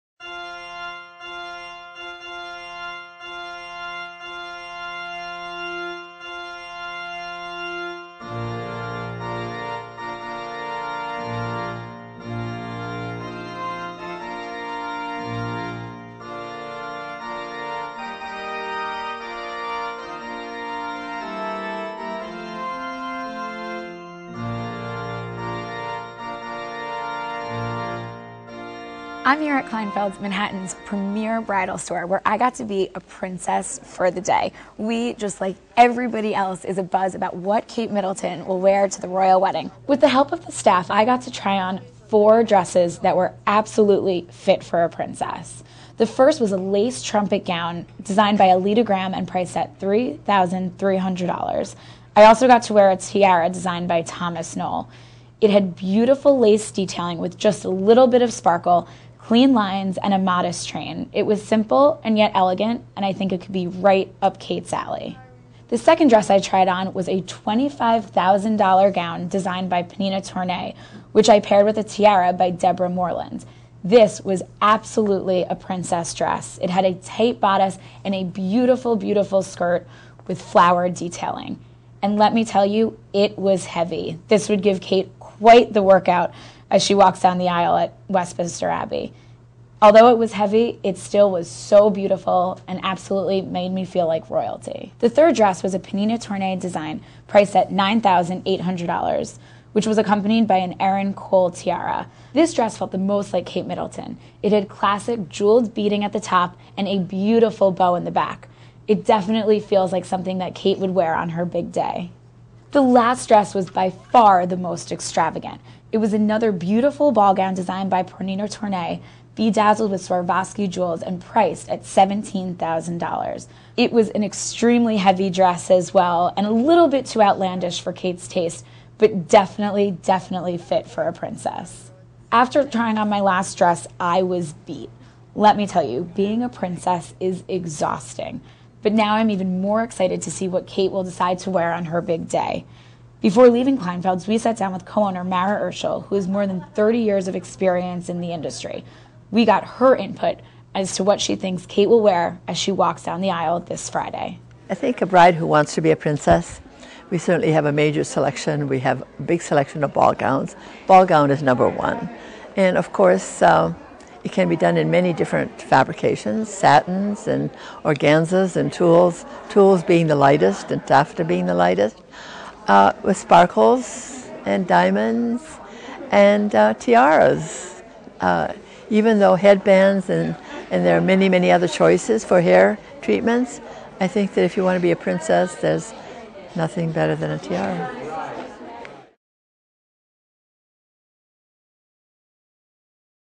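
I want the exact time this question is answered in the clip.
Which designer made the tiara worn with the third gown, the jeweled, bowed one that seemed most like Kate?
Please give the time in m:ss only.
1:40.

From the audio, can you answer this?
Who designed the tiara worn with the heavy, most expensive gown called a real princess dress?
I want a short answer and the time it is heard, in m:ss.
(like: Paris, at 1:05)
Deborah Moreland, at 1:12.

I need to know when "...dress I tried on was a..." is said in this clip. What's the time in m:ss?
1:06.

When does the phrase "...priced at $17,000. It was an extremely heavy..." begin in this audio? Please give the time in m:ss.
2:01.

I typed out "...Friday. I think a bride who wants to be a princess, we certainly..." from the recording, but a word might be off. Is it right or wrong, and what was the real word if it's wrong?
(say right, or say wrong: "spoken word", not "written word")
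right.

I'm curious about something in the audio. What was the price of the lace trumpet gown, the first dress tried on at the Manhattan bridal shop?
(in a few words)
$3,300.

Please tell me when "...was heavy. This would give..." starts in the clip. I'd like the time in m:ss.
1:23.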